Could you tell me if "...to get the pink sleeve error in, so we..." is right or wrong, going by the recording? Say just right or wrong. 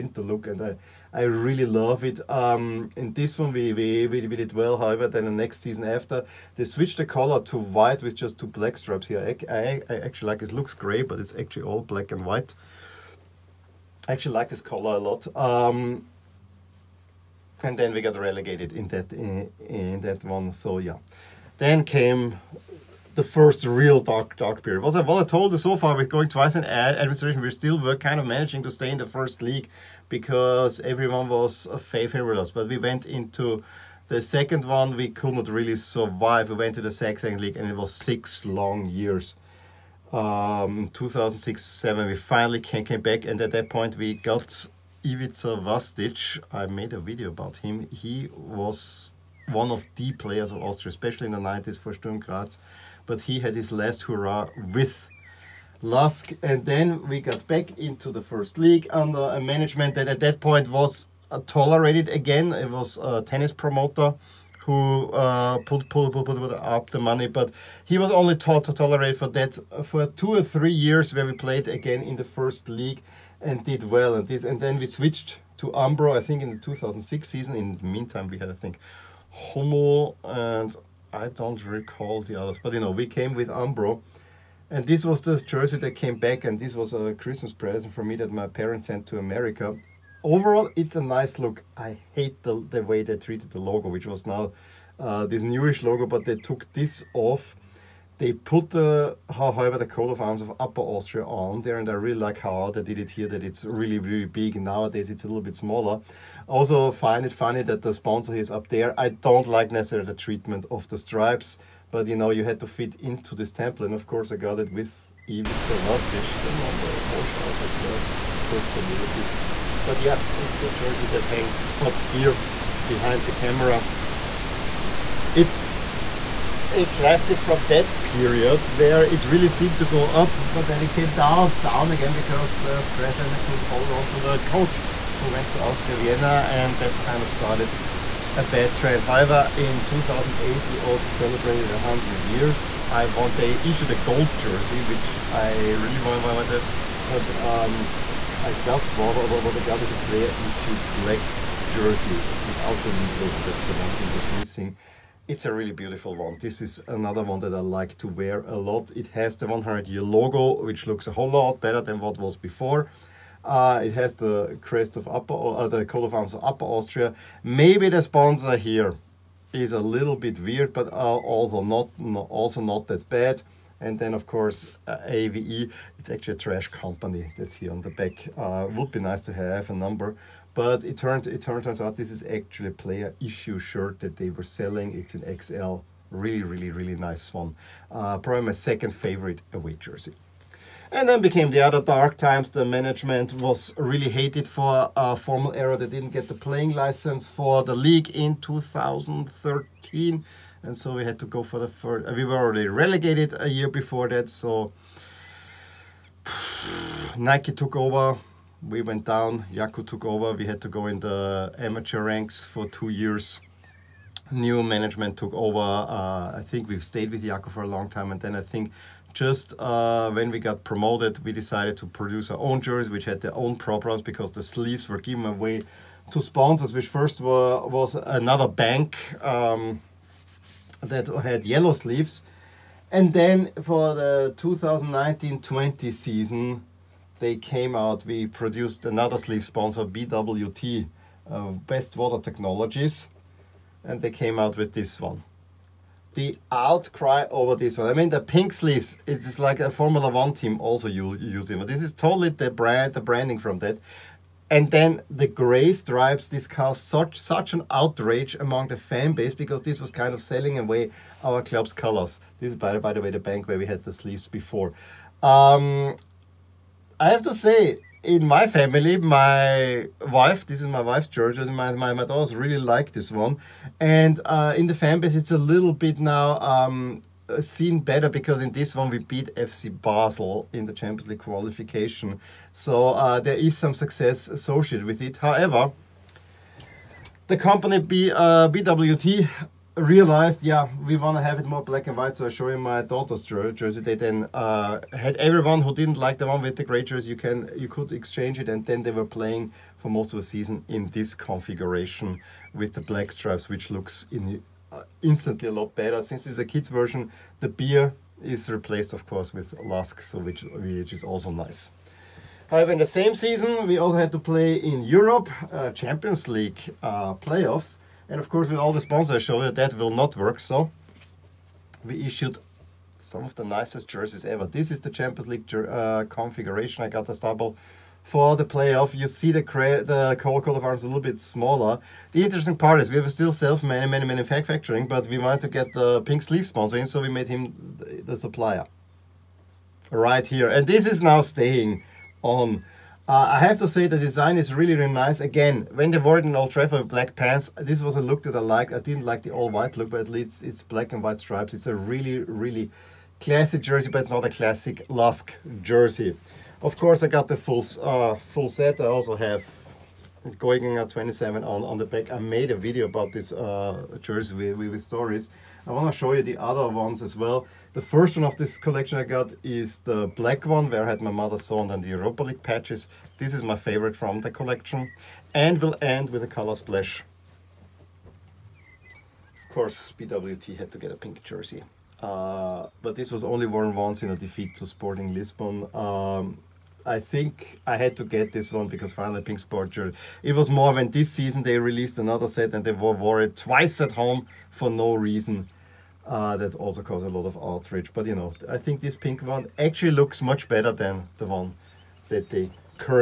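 wrong.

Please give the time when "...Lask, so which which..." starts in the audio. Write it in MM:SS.
05:09.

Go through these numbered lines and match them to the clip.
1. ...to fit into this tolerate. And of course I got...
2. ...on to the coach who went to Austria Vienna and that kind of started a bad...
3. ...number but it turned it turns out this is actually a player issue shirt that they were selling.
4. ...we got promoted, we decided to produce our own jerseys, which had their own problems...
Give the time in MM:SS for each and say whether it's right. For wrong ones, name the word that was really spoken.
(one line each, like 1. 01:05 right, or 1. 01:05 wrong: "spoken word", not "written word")
1. 01:52 wrong: "template", not "tolerate"
2. 02:13 right
3. 02:59 right
4. 03:40 right.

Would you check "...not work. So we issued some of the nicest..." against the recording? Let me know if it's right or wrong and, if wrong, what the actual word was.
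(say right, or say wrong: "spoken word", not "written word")
right.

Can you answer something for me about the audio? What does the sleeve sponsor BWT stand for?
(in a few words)
Best Water Technologies.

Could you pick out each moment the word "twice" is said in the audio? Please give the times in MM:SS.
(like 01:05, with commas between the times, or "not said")
00:26, 06:33.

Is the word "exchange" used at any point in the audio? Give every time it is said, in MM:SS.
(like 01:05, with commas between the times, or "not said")
04:57.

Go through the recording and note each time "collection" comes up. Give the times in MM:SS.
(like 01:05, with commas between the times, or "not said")
06:08, 06:14.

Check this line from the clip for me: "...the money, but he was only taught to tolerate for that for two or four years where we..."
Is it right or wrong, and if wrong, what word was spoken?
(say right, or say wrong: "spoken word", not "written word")
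wrong: "three", not "four".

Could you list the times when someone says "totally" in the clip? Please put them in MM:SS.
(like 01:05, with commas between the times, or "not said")
04:11.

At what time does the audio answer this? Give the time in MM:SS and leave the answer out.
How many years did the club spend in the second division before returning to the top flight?
00:37.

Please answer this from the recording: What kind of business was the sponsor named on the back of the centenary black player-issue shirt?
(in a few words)
A trash company.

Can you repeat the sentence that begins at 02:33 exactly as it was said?
That's the one thing that's missing.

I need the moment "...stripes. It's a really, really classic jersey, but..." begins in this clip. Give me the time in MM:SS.
05:51.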